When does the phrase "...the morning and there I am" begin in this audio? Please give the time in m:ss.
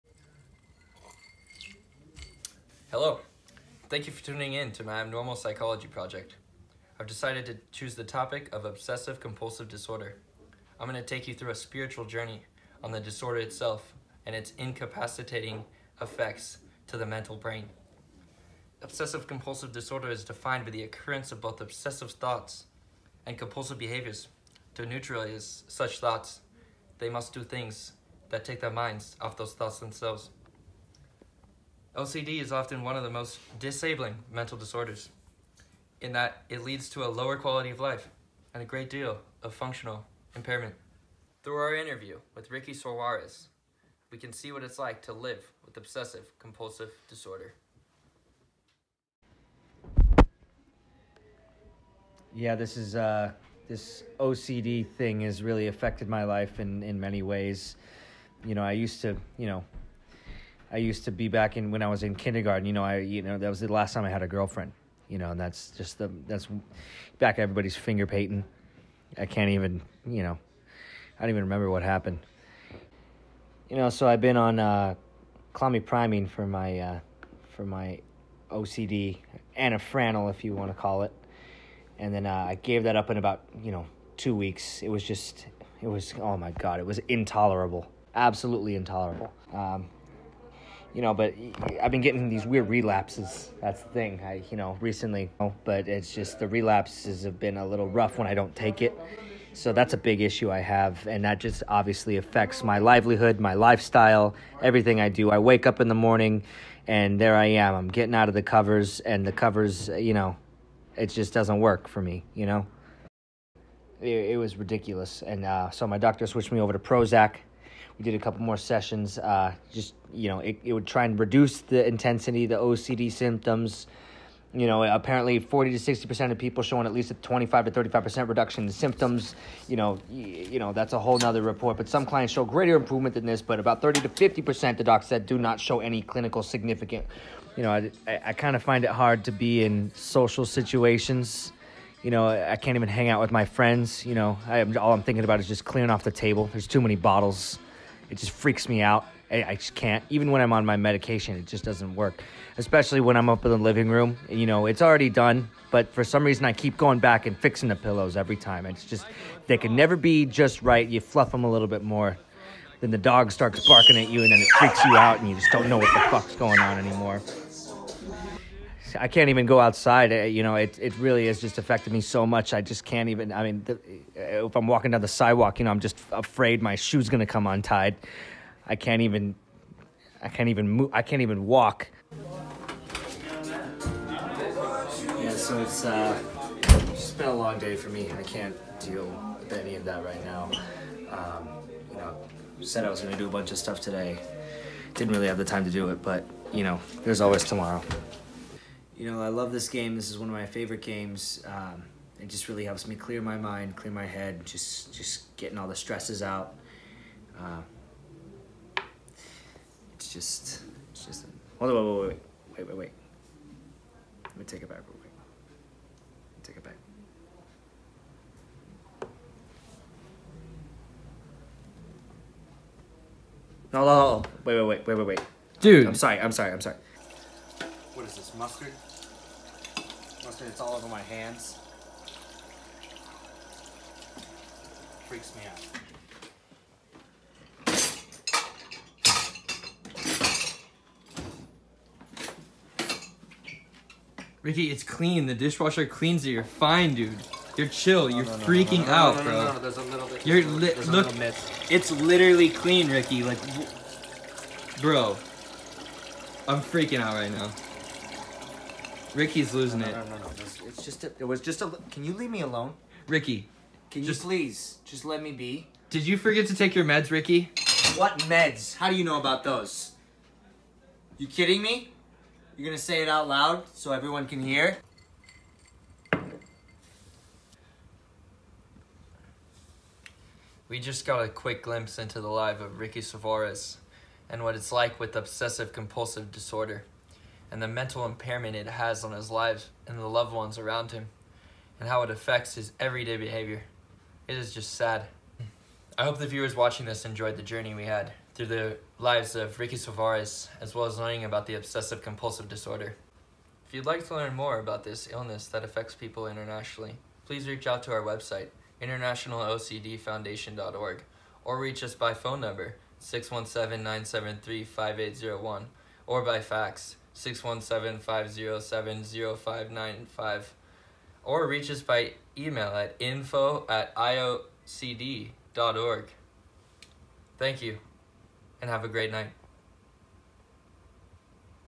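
1:45.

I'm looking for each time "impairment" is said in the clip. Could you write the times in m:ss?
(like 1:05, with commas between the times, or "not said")
0:40, 4:48.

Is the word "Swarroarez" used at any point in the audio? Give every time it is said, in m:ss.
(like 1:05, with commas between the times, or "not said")
0:42.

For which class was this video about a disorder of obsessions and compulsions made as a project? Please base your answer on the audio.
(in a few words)
Abnormal Psychology.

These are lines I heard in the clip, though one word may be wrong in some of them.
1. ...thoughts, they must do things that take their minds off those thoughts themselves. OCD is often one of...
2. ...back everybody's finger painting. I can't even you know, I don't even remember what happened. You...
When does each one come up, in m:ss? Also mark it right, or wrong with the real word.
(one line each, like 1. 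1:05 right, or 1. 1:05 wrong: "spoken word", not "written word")
1. 0:25 right
2. 1:07 right.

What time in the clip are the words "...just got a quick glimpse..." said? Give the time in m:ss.
4:40.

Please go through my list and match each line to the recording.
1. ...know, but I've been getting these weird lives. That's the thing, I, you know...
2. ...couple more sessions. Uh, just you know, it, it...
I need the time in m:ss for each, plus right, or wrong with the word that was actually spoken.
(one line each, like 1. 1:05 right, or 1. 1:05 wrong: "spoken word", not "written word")
1. 1:31 wrong: "relapses", not "lives"
2. 1:58 right.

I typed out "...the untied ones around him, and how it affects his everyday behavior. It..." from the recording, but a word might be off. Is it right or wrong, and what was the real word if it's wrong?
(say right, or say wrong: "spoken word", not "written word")
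wrong: "loved", not "untied".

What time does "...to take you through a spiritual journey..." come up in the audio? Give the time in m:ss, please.
0:11.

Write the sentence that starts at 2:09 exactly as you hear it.
You know, you know that's a whole nother report.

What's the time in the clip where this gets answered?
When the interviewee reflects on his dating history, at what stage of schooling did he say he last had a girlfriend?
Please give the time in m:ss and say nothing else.
1:02.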